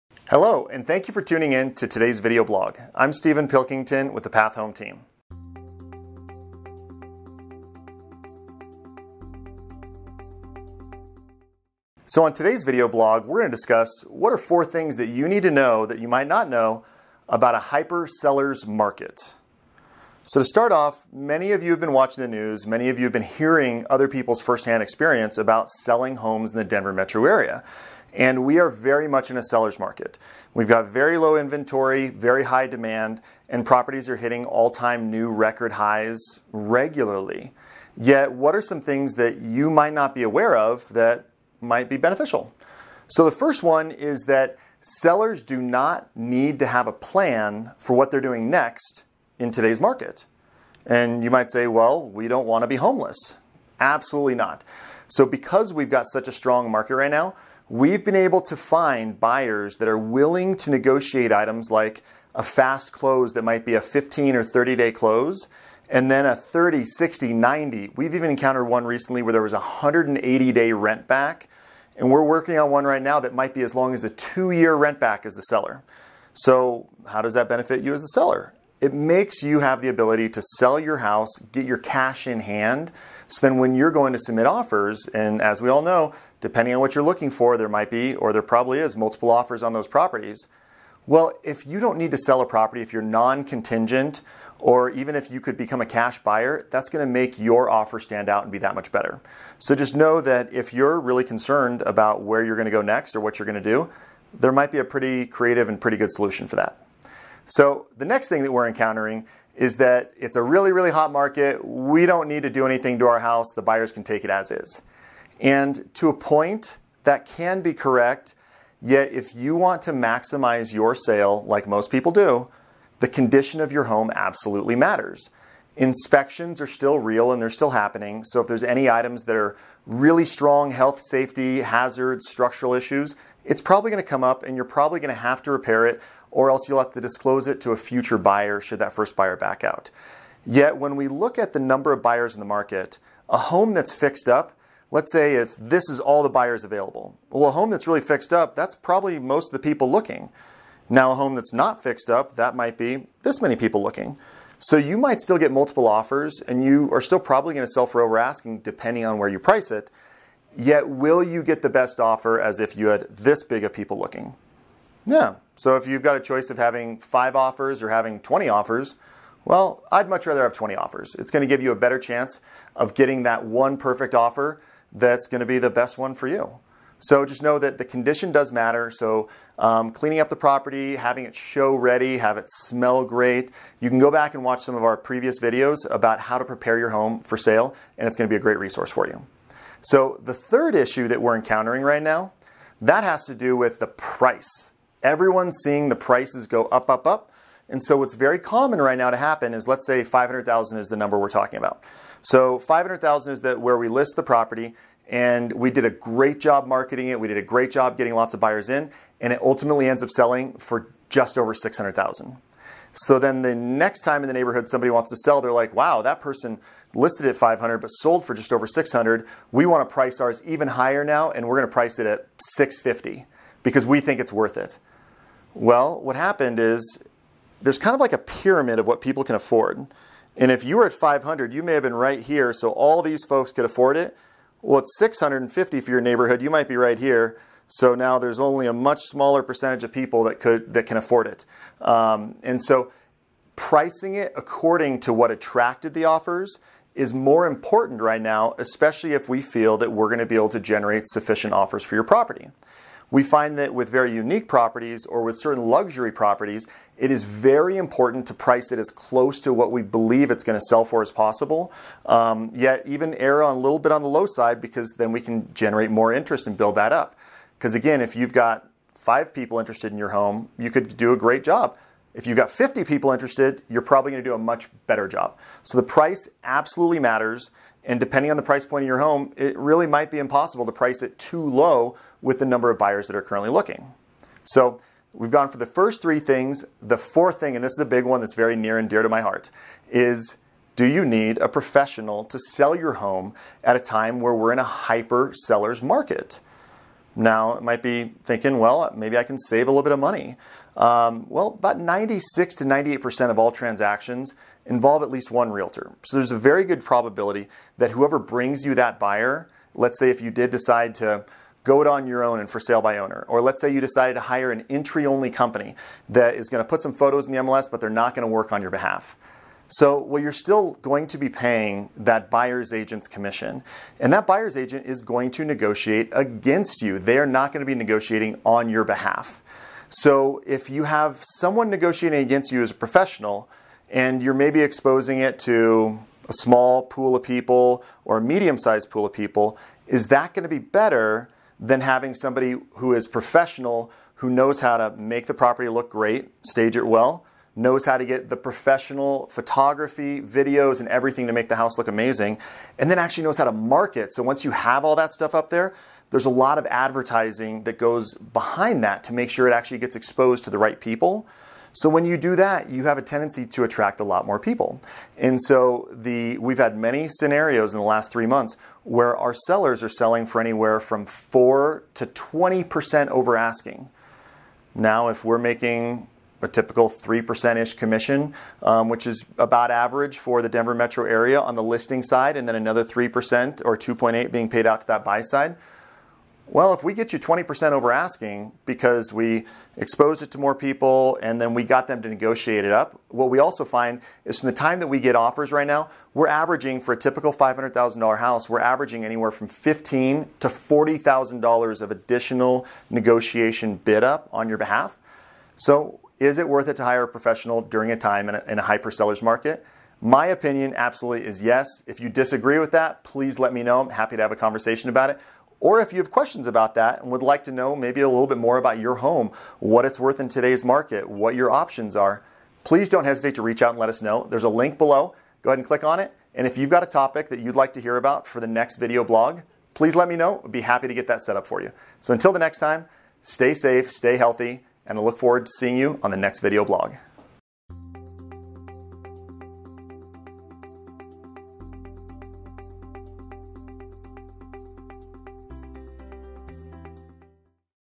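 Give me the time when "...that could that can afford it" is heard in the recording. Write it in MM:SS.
04:00.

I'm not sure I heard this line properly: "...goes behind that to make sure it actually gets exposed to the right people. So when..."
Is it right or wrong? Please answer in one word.
right.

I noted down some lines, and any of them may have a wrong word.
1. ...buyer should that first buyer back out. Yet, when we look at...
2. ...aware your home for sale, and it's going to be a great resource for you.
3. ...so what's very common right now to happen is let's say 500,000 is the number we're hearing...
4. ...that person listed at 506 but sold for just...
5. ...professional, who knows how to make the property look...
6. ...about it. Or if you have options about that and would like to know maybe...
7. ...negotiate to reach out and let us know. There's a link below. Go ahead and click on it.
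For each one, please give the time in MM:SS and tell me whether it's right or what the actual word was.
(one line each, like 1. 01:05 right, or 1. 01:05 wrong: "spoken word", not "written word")
1. 02:18 right
2. 03:06 wrong: "prepare", not "aware"
3. 03:17 wrong: "talking", not "hearing"
4. 03:36 wrong: "500", not "506"
5. 05:43 right
6. 06:54 wrong: "questions", not "options"
7. 07:03 wrong: "hesitate", not "negotiate".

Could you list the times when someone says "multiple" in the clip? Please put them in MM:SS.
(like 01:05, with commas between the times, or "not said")
01:28, 02:35.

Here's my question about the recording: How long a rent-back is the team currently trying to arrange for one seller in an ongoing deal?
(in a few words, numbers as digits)
2 years.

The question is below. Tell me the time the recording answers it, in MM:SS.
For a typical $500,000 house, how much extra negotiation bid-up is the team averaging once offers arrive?
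06:39.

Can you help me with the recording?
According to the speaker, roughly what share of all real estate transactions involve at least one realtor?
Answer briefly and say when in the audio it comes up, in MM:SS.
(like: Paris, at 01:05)
96 to 98%, at 05:01.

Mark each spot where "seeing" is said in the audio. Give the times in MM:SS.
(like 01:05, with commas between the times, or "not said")
03:15, 07:15.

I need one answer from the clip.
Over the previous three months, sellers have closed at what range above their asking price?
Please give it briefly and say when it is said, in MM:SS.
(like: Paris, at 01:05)
4 to 20%, at 06:11.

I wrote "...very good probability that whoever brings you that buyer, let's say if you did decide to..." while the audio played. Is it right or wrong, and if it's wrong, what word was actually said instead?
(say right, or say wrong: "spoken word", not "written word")
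right.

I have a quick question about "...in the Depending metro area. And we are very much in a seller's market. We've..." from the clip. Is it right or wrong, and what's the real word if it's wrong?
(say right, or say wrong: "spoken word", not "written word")
wrong: "Denver", not "Depending".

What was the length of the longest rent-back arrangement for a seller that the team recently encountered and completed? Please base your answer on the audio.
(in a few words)
180 days.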